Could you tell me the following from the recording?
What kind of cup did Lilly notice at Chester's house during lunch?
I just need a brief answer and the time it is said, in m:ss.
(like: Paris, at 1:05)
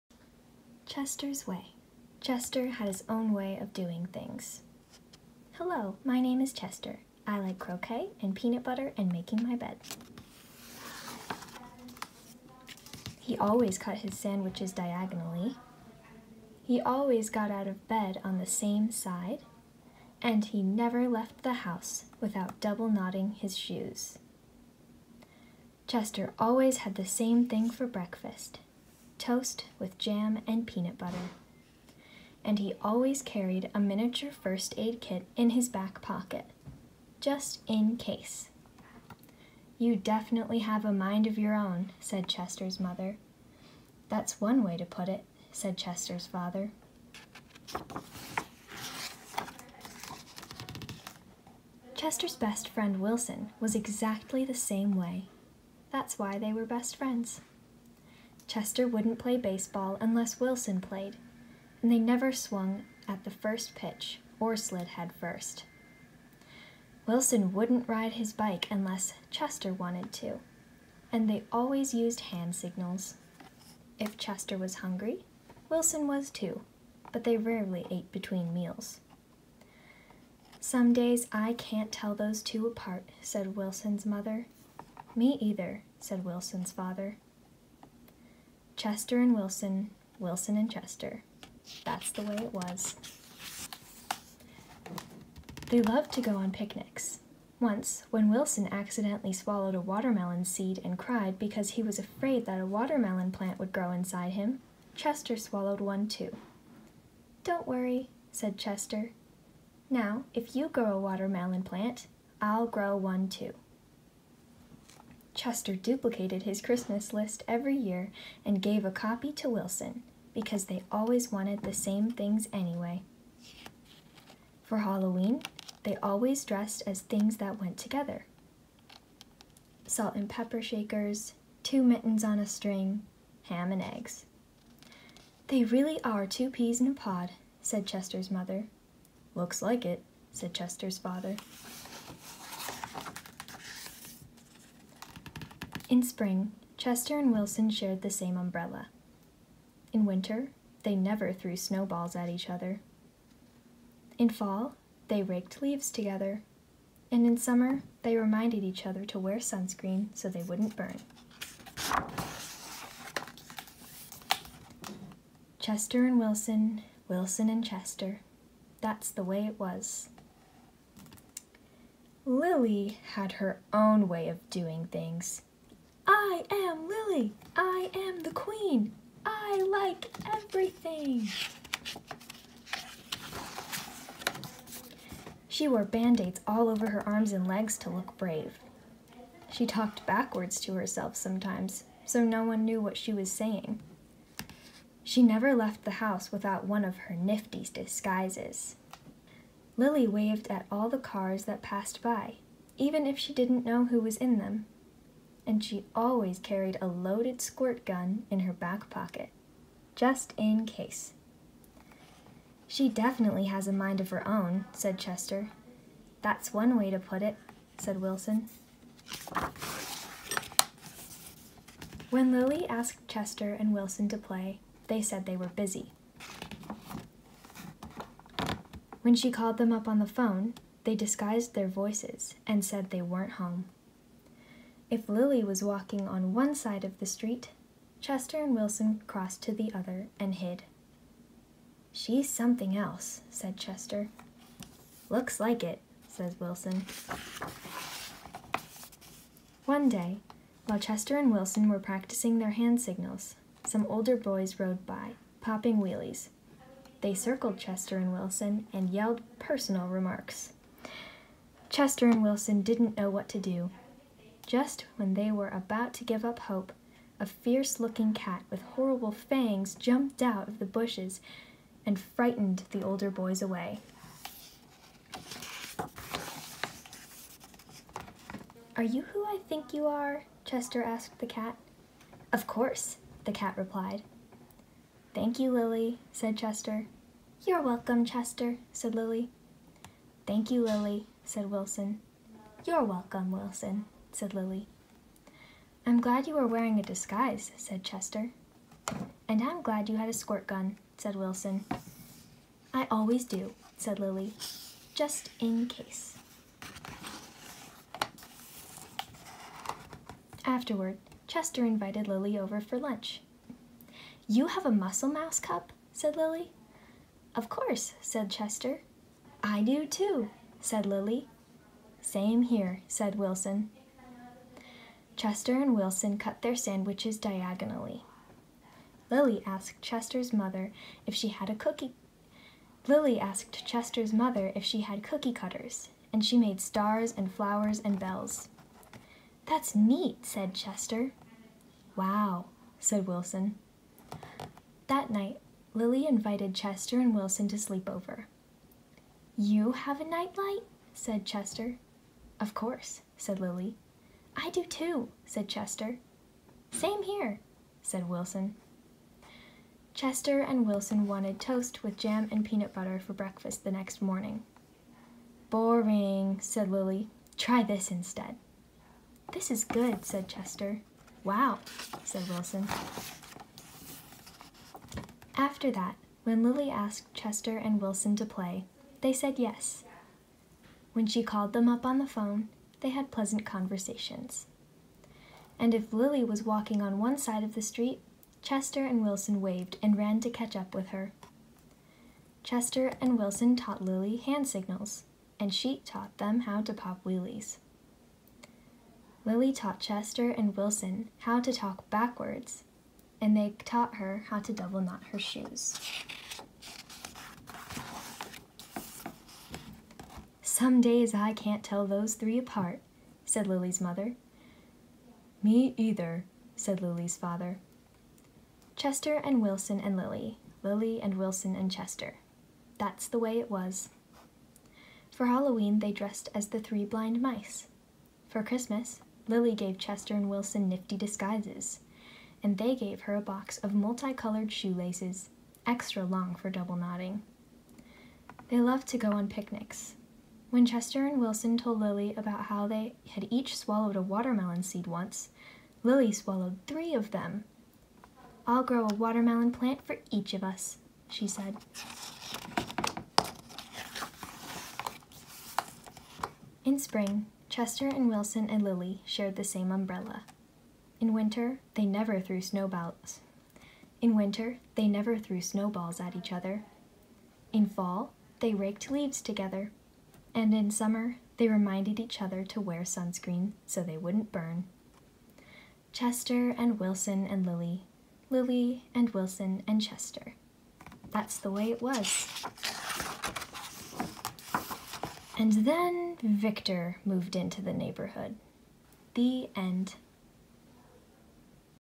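Muscle mouse cup, at 5:14.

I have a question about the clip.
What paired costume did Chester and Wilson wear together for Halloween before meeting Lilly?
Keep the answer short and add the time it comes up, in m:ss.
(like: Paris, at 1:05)
Ham and eggs, at 2:13.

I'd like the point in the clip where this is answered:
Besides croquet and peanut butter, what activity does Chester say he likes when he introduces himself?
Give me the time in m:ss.
0:09.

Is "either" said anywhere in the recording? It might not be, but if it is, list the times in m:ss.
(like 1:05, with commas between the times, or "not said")
1:25, 6:55.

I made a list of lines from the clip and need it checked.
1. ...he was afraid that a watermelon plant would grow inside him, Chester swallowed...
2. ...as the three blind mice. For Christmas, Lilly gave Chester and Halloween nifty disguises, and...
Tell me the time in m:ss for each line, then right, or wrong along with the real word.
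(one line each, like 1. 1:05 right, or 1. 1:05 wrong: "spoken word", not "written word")
1. 1:41 right
2. 7:06 wrong: "Wilson", not "Halloween".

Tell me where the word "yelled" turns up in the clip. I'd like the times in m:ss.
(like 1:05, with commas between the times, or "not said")
4:18.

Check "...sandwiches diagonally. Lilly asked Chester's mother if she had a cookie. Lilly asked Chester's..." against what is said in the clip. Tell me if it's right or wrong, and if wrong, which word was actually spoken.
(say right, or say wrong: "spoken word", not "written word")
right.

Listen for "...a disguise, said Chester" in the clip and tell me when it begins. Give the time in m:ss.
4:56.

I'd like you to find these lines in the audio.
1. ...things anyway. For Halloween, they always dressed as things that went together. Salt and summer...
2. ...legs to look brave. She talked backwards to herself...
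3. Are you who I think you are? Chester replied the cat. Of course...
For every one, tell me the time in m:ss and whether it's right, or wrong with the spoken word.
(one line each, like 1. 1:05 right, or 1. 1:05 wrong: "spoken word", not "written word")
1. 2:02 wrong: "pepper", not "summer"
2. 3:07 right
3. 4:38 wrong: "asked", not "replied".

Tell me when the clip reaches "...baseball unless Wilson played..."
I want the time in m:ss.
0:59.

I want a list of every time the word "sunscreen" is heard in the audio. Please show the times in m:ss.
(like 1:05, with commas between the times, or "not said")
2:39, 7:52.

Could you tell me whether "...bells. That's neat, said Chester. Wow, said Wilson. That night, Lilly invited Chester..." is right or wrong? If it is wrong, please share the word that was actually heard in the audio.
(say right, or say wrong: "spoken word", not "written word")
right.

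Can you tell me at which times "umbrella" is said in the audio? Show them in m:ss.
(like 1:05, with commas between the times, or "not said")
2:28, 7:39.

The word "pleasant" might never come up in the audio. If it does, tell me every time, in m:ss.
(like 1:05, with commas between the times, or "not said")
6:23.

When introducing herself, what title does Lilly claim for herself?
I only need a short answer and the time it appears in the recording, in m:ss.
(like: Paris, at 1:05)
The queen, at 2:58.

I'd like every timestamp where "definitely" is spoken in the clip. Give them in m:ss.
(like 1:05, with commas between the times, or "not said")
0:39, 3:32.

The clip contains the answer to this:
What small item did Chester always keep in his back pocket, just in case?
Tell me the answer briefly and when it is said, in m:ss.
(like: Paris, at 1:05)
Miniature first aid kit, at 0:33.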